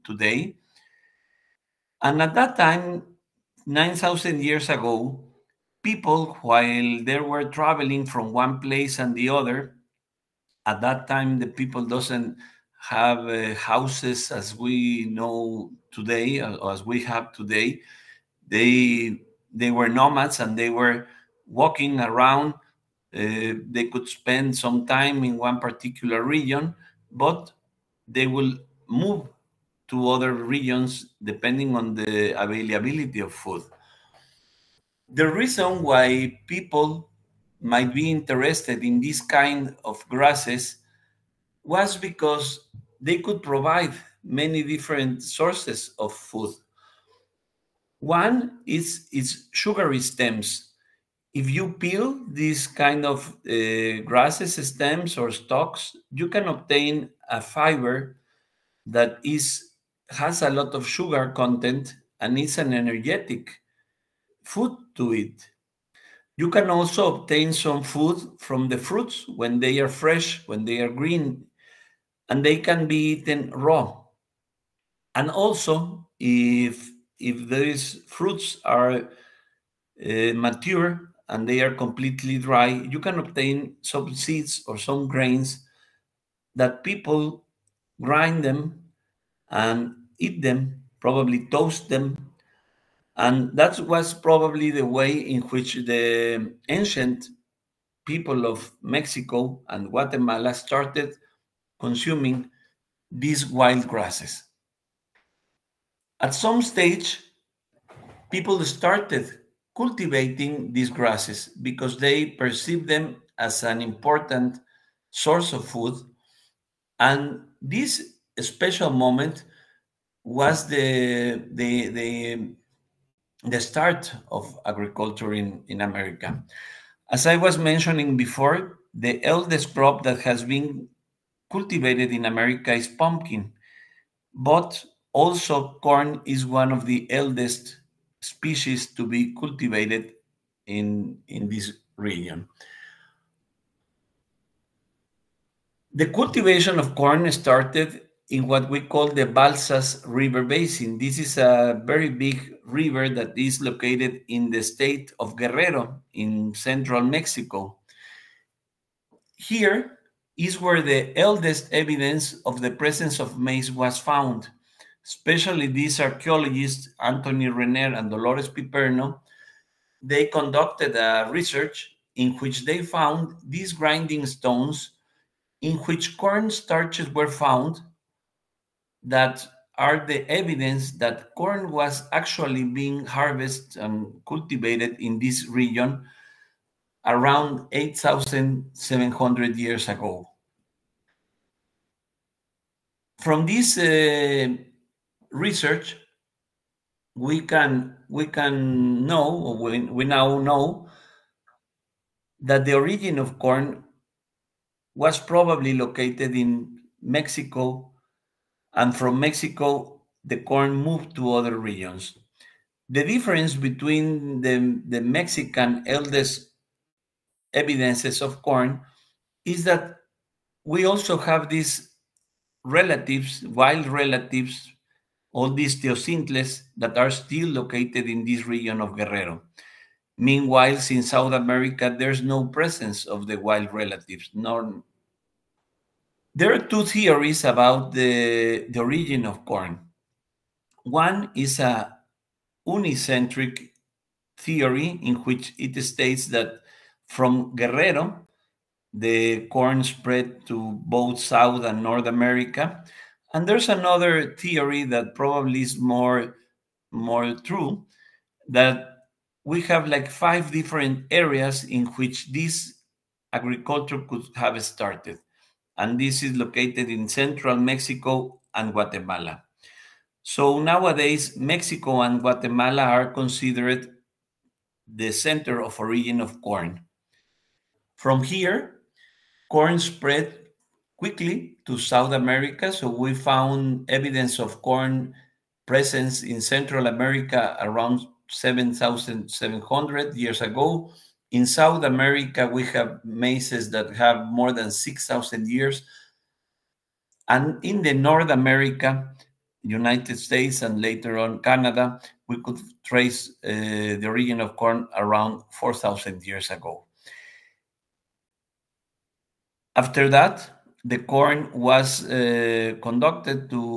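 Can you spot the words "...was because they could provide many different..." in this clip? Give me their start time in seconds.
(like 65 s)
41 s.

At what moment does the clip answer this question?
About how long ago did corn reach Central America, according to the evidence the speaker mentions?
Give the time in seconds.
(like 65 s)
288 s.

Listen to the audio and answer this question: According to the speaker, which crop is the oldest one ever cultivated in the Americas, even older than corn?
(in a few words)
Pumpkin.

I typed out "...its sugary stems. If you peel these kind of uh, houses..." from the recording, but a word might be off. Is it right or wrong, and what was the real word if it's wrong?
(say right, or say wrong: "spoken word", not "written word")
wrong: "grasses", not "houses".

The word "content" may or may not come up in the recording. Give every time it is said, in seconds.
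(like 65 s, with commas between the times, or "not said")
61 s.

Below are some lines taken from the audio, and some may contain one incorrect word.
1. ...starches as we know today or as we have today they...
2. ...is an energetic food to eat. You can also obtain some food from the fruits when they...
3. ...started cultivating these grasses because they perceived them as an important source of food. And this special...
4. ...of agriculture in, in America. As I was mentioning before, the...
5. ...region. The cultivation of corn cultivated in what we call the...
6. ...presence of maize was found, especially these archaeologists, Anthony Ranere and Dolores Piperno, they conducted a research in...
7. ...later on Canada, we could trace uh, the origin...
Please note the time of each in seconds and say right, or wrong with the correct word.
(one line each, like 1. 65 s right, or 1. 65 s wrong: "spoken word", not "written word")
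1. 13 s wrong: "houses", not "starches"
2. 62 s right
3. 108 s right
4. 124 s right
5. 141 s wrong: "started", not "cultivated"
6. 162 s right
7. 300 s right.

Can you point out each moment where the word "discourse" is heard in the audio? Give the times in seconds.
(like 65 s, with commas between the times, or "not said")
not said.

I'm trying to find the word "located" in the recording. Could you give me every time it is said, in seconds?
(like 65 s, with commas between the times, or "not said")
153 s, 205 s, 227 s, 266 s.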